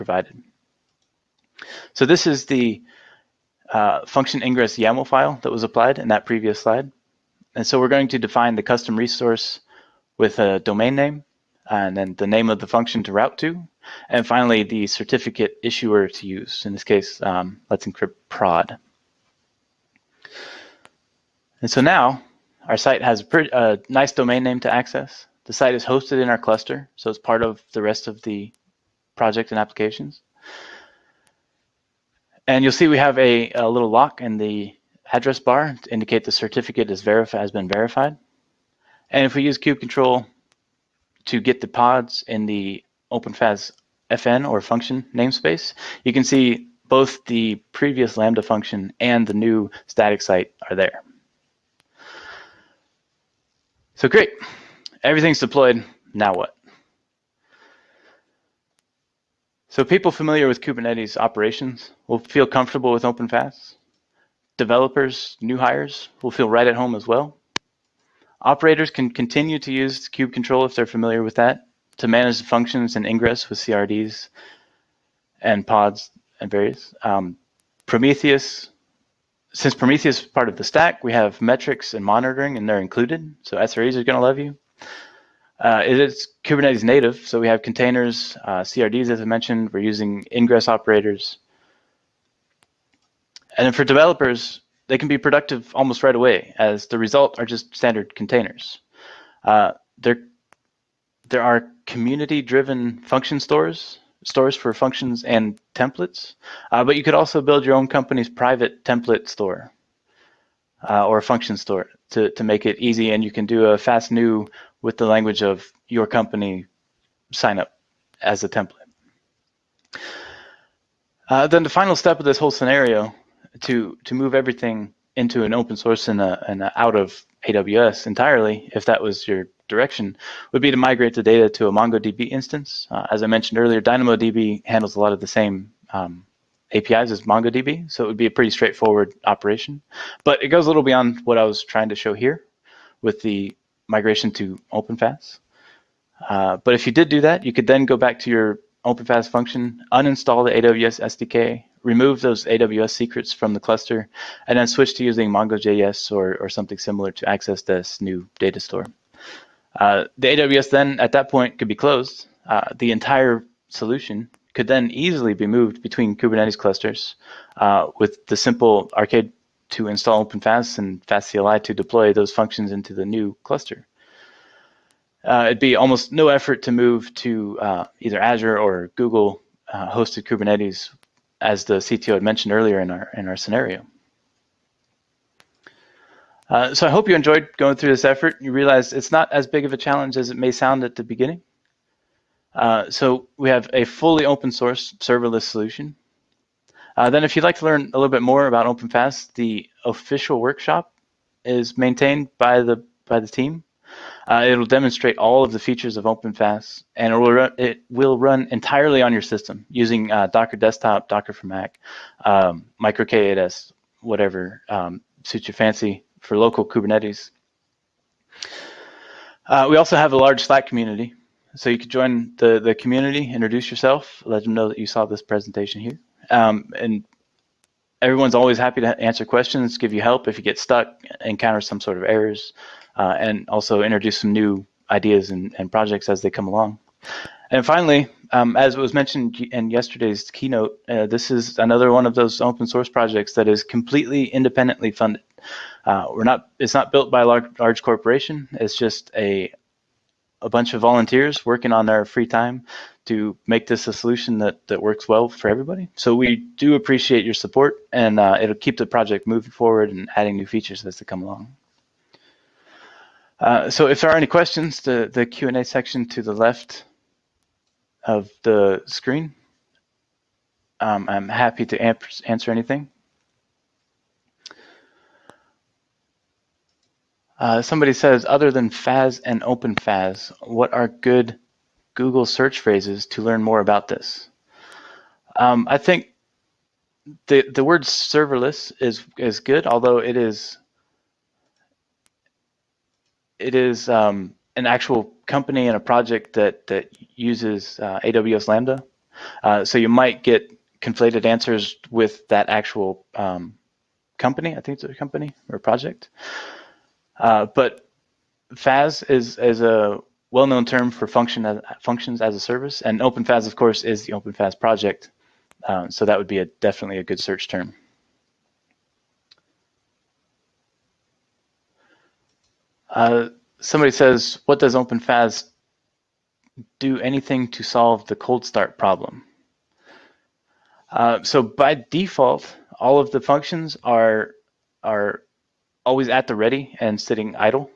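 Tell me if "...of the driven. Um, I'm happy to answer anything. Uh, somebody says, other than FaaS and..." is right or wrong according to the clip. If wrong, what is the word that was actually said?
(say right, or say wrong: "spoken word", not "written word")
wrong: "screen", not "driven".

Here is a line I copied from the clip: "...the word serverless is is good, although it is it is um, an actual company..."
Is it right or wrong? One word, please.
right.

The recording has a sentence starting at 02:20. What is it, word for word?
But it goes a little beyond what I was trying to show here with the migration to OpenFaaS.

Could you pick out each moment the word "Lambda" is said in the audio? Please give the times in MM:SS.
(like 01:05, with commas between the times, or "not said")
00:48, 04:58.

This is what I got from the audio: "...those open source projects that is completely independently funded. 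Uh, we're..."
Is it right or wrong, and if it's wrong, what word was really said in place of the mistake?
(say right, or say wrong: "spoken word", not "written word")
right.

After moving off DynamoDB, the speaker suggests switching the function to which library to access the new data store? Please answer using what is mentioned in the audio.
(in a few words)
MongoJS.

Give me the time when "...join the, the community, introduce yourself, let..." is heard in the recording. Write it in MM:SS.
03:41.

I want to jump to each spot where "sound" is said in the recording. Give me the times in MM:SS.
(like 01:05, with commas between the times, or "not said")
03:10.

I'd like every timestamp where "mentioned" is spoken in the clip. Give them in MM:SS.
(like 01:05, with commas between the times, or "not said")
01:29, 02:13, 03:02, 03:58.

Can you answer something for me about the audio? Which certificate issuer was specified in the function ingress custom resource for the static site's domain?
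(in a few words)
Let's Encrypt prod.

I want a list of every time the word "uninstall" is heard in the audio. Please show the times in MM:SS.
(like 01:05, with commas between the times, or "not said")
02:29.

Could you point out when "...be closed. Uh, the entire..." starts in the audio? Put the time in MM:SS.
02:41.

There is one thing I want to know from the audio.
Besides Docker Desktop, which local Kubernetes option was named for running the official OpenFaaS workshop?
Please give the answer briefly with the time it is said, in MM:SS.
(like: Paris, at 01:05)
MicroK8s, at 03:32.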